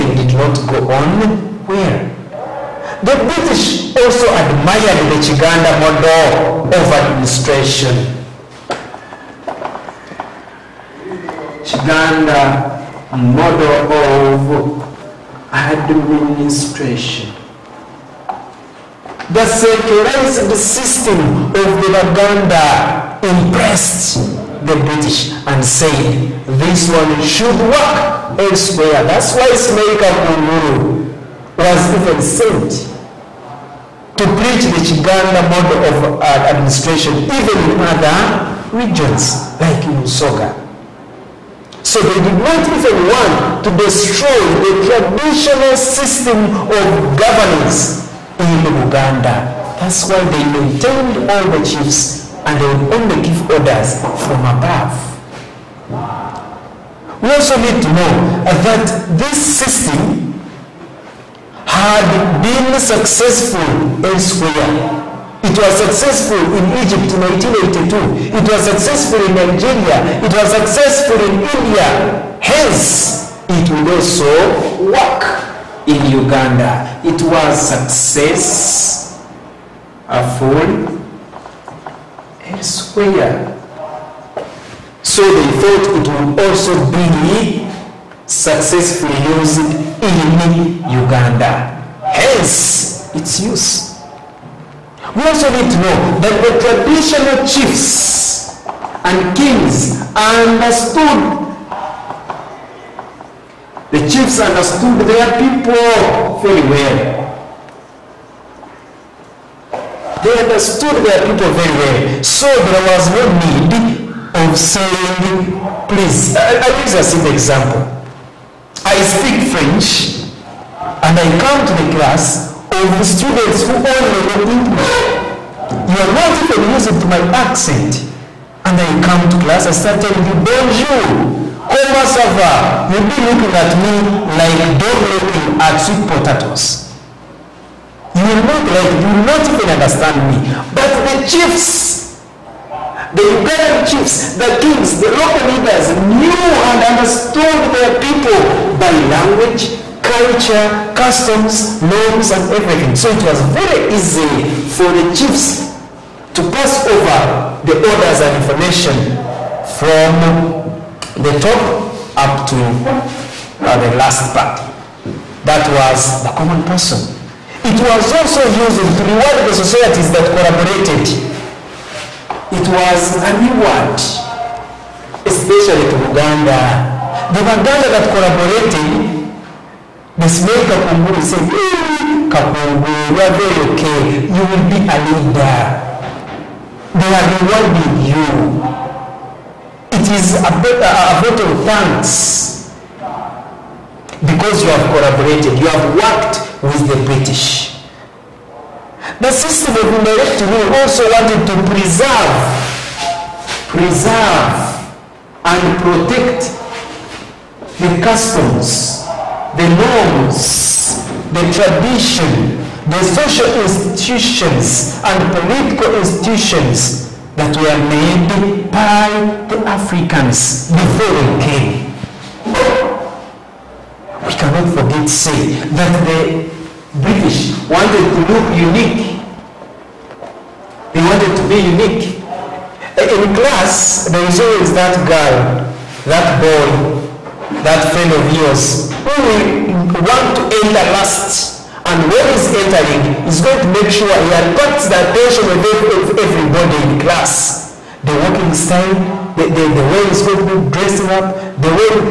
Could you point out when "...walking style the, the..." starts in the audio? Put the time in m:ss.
4:08.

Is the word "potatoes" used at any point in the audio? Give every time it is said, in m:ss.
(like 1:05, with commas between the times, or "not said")
2:16.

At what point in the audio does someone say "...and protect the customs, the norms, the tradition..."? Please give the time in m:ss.
3:25.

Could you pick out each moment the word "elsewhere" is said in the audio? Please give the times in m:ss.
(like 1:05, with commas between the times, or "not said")
0:28, 1:04, 1:22.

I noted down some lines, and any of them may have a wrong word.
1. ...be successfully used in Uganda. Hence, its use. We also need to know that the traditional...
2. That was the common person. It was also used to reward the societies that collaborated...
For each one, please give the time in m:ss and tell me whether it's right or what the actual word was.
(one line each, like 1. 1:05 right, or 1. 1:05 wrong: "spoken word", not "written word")
1. 1:26 right
2. 2:45 right.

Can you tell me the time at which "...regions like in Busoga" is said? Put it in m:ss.
0:38.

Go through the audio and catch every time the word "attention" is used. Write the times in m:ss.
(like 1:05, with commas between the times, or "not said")
4:05.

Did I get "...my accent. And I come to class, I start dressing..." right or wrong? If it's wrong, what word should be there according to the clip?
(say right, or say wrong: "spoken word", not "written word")
wrong: "telling", not "dressing".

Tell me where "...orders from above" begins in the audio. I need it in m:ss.
0:53.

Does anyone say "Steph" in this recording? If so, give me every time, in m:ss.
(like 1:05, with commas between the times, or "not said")
not said.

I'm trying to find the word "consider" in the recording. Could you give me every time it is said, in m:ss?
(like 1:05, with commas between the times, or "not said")
not said.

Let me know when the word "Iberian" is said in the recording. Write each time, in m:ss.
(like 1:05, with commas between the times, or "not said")
2:23.